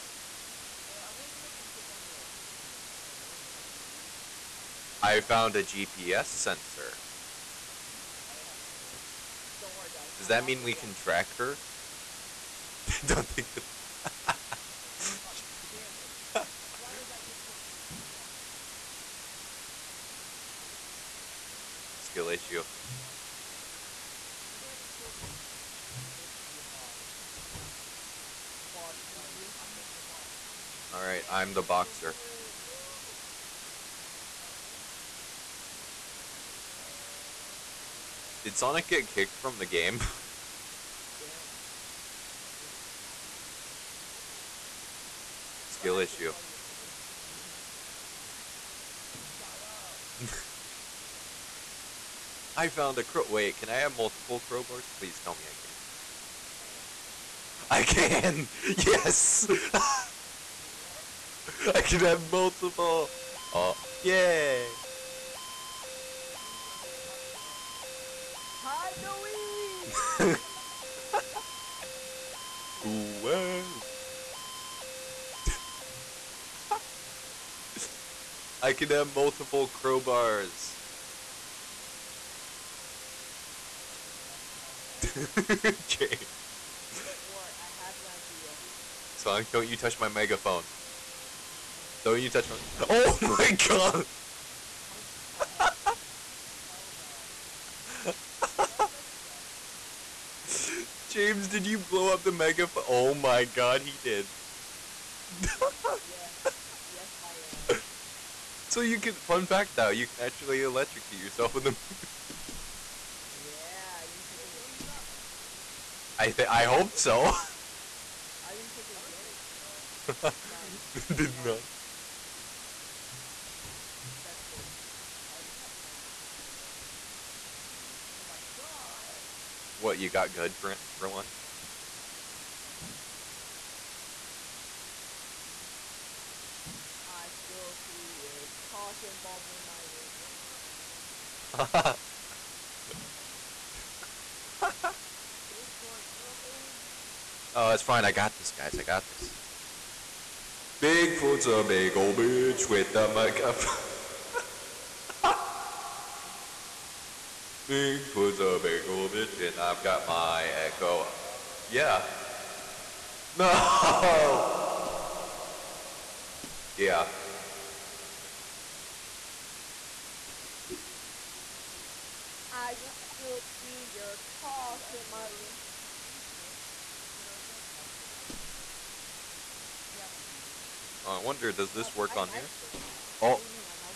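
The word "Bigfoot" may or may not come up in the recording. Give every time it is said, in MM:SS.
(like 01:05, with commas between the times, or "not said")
01:54, 02:25, 02:30, 02:37.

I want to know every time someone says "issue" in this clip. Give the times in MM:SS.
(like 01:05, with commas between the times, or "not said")
00:22, 00:45.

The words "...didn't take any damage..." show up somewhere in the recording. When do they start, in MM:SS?
01:58.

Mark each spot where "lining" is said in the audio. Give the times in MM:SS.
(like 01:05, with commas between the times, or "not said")
not said.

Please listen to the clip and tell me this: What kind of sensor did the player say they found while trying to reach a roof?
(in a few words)
GPS sensor.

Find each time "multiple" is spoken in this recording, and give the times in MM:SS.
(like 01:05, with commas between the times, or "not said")
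00:53, 01:02, 01:19.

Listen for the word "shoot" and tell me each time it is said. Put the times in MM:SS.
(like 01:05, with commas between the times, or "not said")
03:00.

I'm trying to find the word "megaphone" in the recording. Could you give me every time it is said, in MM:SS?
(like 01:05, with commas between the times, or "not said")
01:30, 01:42, 02:21, 02:33.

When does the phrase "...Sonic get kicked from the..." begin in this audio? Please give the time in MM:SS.
00:38.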